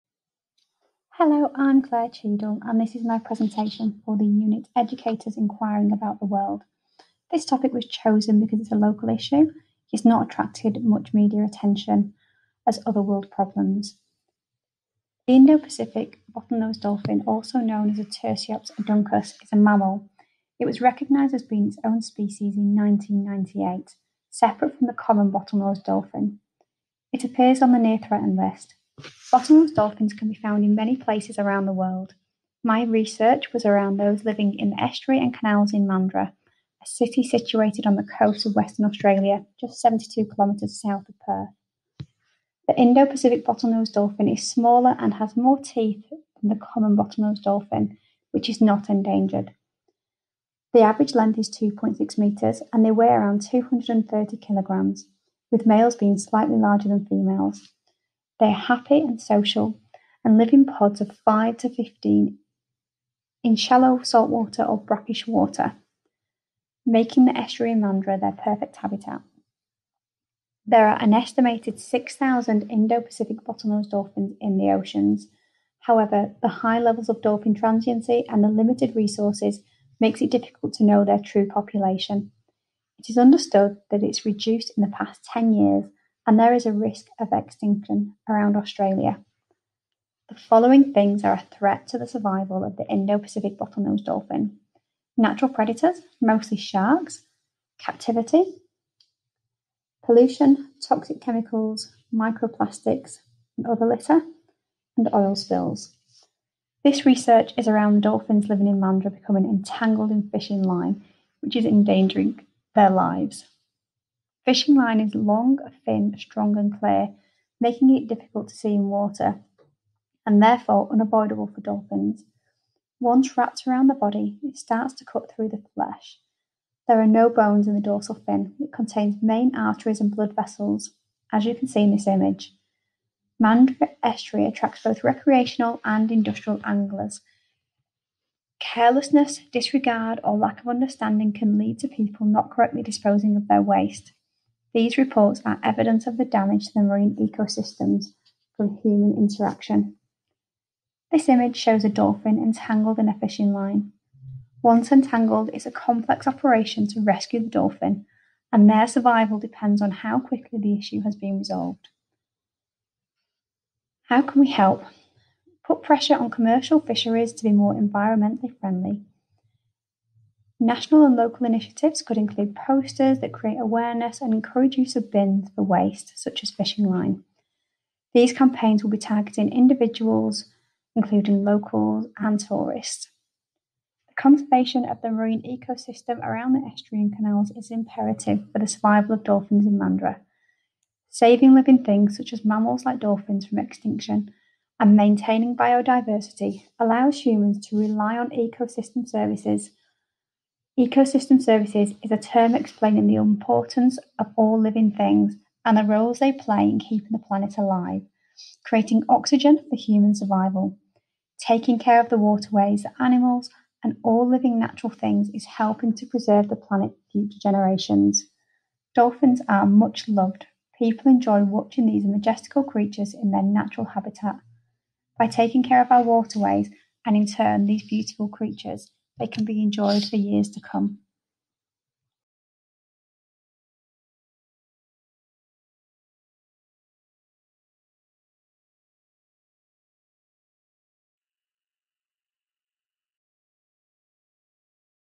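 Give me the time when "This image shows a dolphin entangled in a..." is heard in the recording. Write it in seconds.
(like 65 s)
151 s.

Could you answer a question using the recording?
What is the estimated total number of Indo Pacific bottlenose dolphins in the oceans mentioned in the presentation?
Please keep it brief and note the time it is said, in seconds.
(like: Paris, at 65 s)
6,000, at 71 s.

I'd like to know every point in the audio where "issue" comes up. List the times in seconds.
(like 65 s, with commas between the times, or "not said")
9 s, 160 s.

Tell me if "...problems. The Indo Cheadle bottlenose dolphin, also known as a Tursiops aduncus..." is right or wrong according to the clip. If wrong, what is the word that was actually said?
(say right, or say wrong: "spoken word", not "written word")
wrong: "Pacific", not "Cheadle".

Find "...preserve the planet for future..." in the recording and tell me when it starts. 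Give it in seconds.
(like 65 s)
216 s.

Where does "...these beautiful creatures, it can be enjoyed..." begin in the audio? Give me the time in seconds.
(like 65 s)
227 s.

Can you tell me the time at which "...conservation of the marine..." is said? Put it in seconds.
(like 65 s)
184 s.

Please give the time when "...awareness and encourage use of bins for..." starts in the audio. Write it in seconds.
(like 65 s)
173 s.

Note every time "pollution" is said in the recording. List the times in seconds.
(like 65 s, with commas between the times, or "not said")
100 s.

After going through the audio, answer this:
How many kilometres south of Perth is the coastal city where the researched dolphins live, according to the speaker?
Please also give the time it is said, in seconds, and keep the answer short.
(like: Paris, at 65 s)
72, at 39 s.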